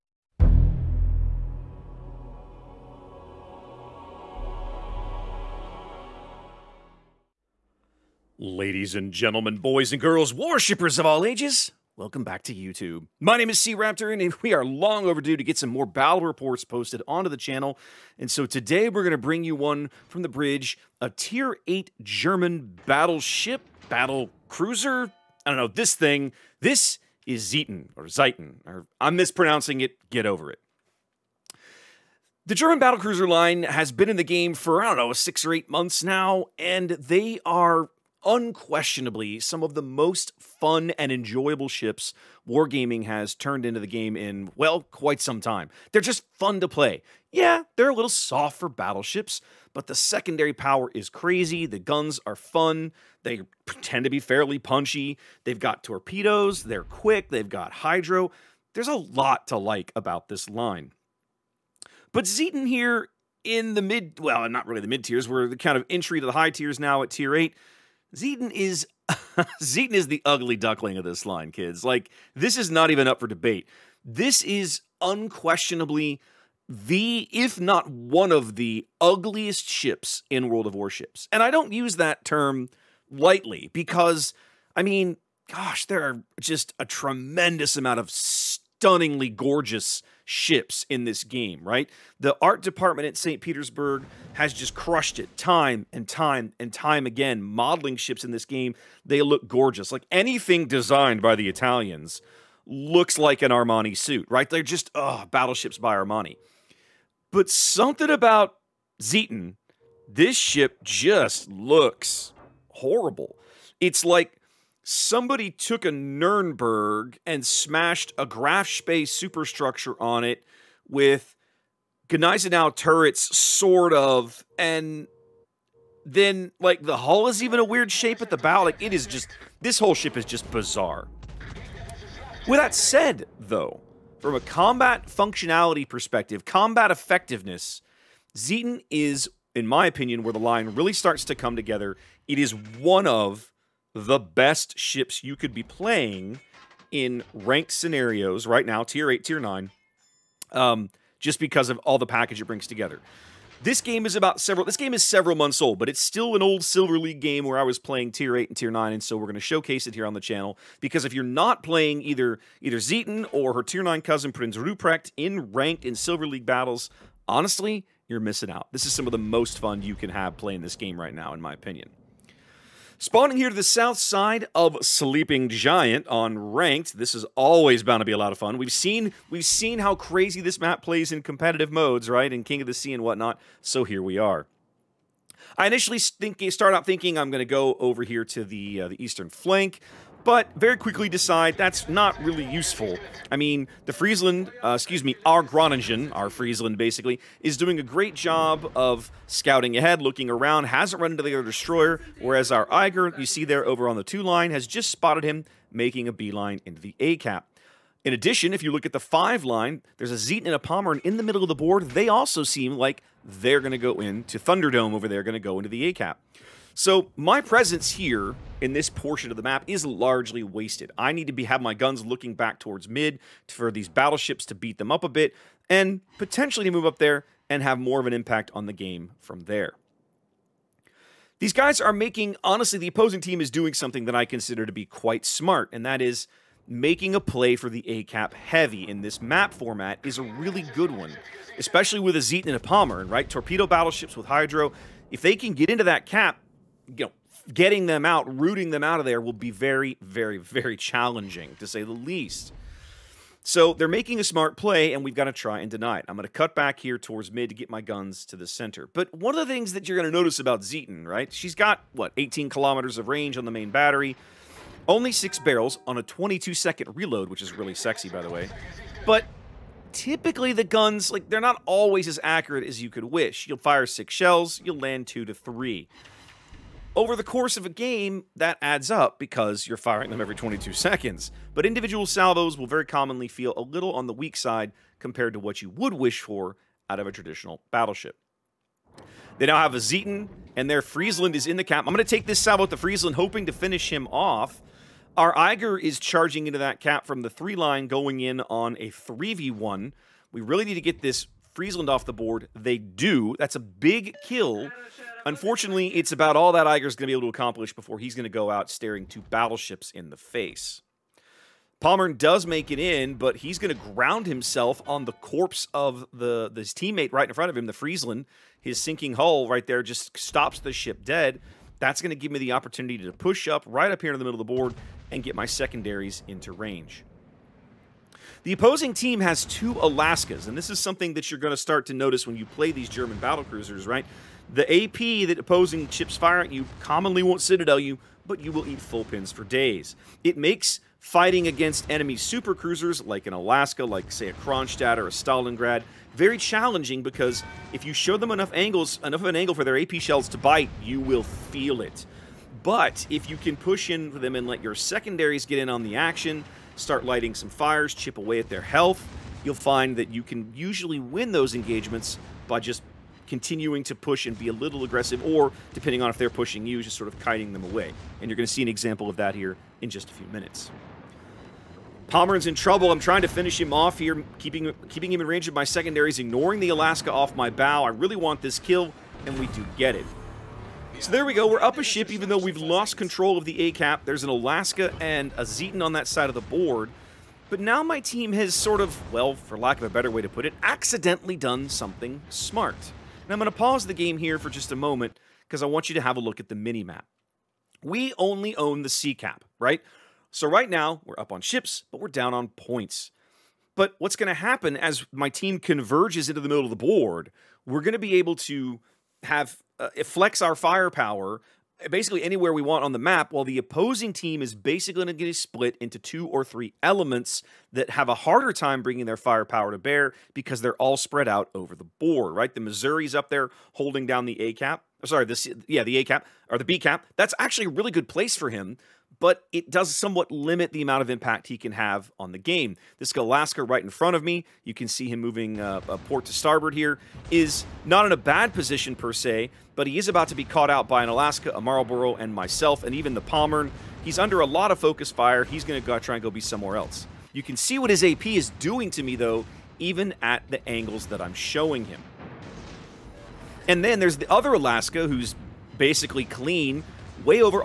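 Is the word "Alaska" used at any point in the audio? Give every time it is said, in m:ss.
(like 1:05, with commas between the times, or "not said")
5:29, 5:43, 6:16, 6:24, 7:13, 7:21, 7:34.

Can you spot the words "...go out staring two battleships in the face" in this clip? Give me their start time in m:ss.
5:08.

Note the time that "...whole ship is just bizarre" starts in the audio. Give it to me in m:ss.
2:09.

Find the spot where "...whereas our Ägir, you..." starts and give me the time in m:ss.
3:22.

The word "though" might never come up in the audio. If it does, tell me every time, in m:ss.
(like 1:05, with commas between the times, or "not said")
2:13, 6:22, 7:29.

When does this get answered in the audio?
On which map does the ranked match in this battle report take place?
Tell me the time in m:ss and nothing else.
2:54.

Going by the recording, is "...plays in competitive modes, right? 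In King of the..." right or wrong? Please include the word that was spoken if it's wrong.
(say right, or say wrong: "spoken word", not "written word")
right.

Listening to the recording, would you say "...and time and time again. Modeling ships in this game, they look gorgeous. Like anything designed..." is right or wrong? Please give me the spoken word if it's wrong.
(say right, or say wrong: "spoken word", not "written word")
right.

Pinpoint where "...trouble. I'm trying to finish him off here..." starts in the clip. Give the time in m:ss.
6:12.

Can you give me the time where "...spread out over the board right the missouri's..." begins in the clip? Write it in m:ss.
7:00.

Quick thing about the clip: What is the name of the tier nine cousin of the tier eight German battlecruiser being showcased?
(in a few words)
Prinz Rupprecht.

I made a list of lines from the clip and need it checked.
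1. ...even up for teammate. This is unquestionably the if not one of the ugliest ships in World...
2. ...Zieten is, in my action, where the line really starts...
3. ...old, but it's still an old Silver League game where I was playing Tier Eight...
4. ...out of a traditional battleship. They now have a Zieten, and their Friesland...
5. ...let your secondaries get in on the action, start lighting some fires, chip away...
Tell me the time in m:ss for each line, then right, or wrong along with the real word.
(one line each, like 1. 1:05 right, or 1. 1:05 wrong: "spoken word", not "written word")
1. 1:12 wrong: "debate", not "teammate"
2. 2:18 wrong: "opinion", not "action"
3. 2:35 right
4. 4:46 right
5. 5:54 right.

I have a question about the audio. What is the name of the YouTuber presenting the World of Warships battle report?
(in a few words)
SeaRaptor.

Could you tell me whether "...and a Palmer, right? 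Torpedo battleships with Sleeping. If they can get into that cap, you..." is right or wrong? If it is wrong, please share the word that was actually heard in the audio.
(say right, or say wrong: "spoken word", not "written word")
wrong: "Hydro", not "Sleeping".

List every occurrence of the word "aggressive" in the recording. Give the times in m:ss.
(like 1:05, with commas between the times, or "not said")
6:04.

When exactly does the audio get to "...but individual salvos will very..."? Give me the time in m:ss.
4:41.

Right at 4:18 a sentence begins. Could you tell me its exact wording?
But one of the things that you're going to notice about Zieten, right?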